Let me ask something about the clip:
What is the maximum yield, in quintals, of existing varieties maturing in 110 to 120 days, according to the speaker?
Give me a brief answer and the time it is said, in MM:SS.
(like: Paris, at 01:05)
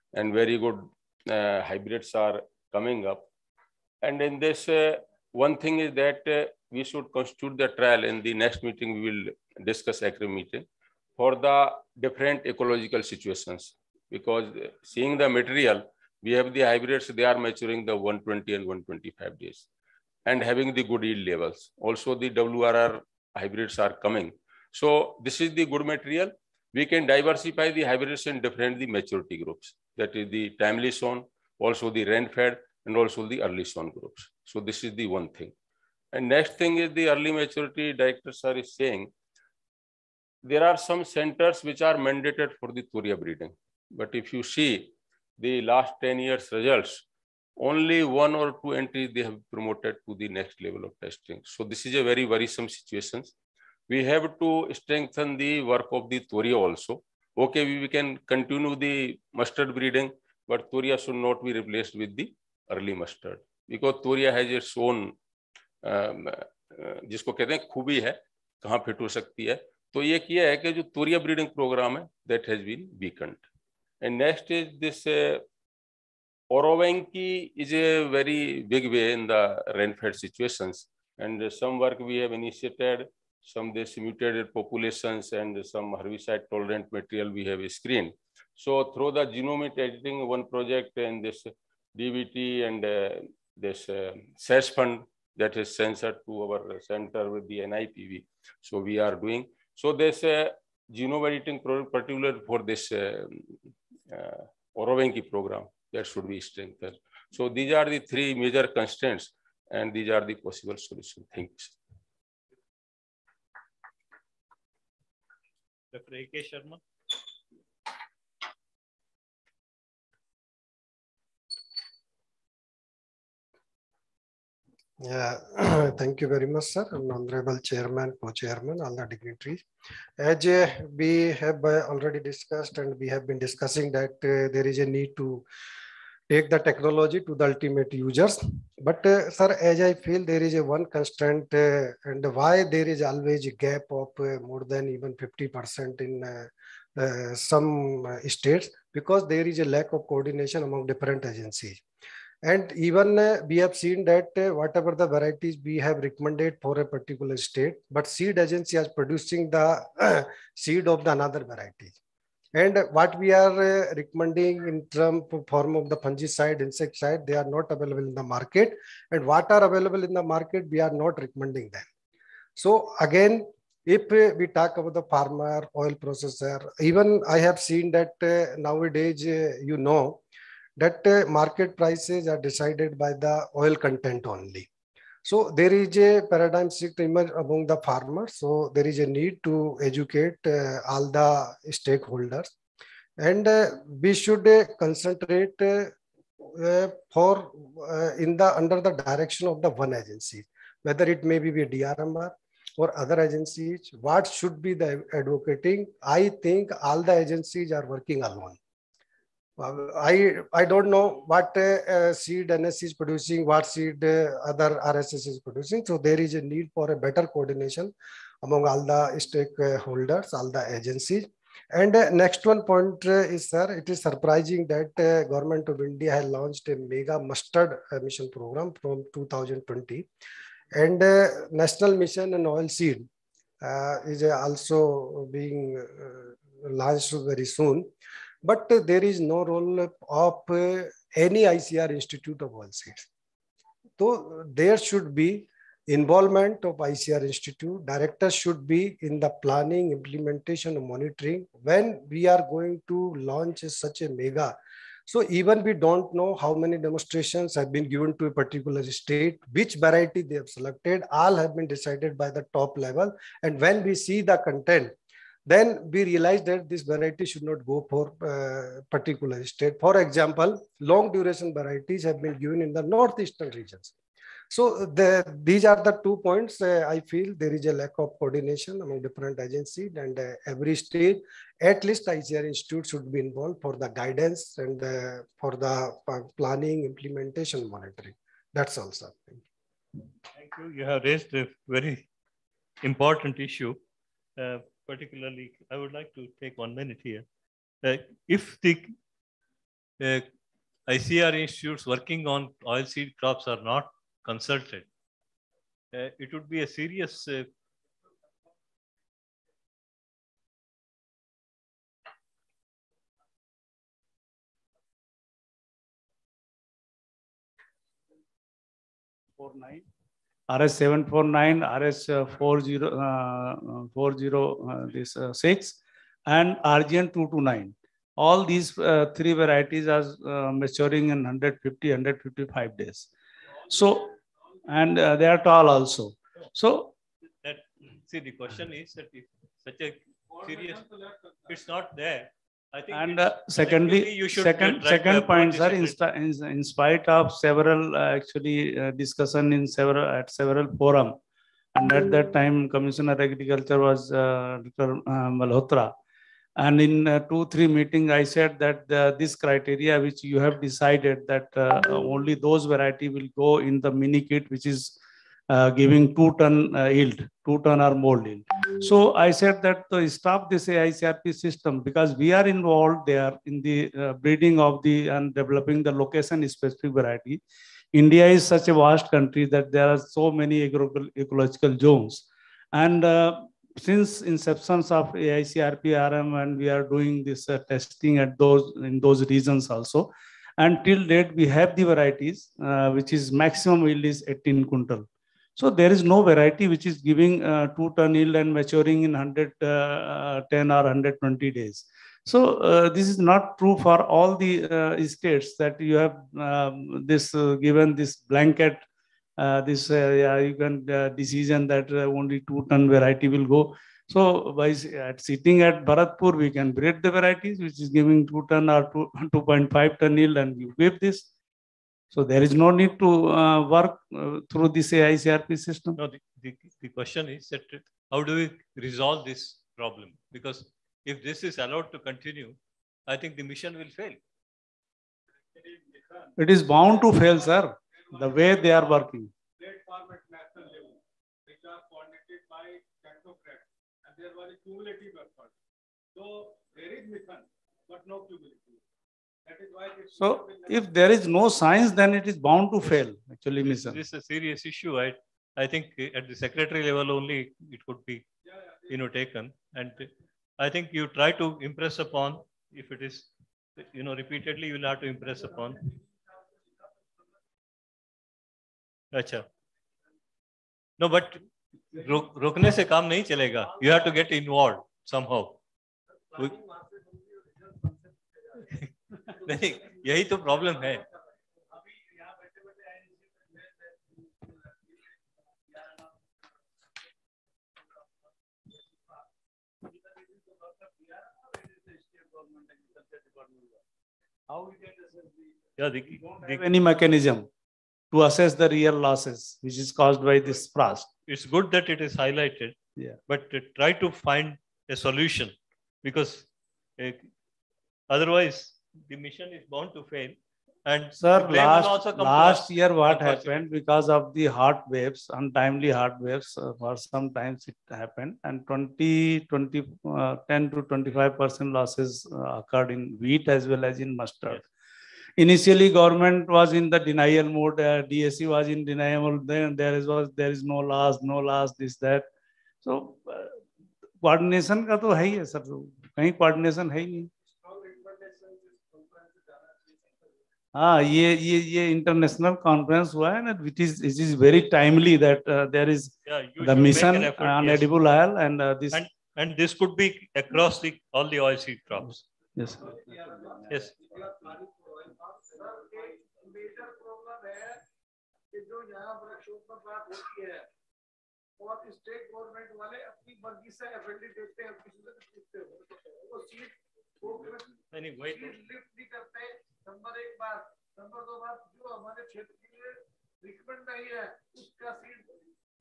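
18, at 06:34.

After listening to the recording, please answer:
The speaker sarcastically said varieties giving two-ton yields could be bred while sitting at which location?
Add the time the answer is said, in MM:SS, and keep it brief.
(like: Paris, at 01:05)
Bharatpur, at 06:55.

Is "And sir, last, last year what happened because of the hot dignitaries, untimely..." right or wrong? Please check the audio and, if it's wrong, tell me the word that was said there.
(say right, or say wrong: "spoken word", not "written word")
wrong: "waves", not "dignitaries".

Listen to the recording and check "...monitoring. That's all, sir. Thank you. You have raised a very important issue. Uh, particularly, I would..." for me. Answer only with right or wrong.
right.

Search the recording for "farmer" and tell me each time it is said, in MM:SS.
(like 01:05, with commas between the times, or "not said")
02:55, 03:07.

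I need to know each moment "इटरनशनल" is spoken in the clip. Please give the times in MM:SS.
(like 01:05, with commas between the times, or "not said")
09:01.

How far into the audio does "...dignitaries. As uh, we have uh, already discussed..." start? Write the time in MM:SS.
02:09.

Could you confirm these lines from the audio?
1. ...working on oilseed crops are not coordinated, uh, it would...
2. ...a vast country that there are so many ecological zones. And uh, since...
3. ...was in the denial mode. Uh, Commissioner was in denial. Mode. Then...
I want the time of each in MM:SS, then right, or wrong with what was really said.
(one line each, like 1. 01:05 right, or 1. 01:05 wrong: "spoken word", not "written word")
1. 05:01 wrong: "consulted", not "coordinated"
2. 06:18 right
3. 08:46 wrong: "DSC", not "Commissioner".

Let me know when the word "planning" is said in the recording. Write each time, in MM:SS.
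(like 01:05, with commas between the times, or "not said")
04:09, 04:46.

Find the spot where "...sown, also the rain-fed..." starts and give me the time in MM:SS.
00:30.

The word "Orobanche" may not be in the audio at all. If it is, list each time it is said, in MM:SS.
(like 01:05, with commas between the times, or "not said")
01:16, 01:44.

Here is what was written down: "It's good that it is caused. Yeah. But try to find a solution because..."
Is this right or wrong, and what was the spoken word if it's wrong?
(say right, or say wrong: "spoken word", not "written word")
wrong: "highlighted", not "caused".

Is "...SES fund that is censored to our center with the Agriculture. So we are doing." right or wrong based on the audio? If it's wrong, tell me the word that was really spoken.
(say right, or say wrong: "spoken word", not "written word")
wrong: "NIPB", not "Agriculture".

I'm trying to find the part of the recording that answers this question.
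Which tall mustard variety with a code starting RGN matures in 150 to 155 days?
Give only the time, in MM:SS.
05:26.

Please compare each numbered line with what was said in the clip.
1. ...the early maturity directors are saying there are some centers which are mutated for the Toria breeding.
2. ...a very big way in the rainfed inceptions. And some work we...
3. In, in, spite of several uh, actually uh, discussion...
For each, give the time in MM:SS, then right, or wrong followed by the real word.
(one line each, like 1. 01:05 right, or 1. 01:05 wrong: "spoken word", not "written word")
1. 00:36 wrong: "mandated", not "mutated"
2. 01:17 wrong: "situations", not "inceptions"
3. 05:45 right.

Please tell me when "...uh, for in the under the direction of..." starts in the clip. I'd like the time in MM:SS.
03:16.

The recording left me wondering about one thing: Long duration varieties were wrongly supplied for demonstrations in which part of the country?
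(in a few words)
northeastern regions.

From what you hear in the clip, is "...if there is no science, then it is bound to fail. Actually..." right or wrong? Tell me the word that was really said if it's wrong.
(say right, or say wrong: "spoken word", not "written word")
right.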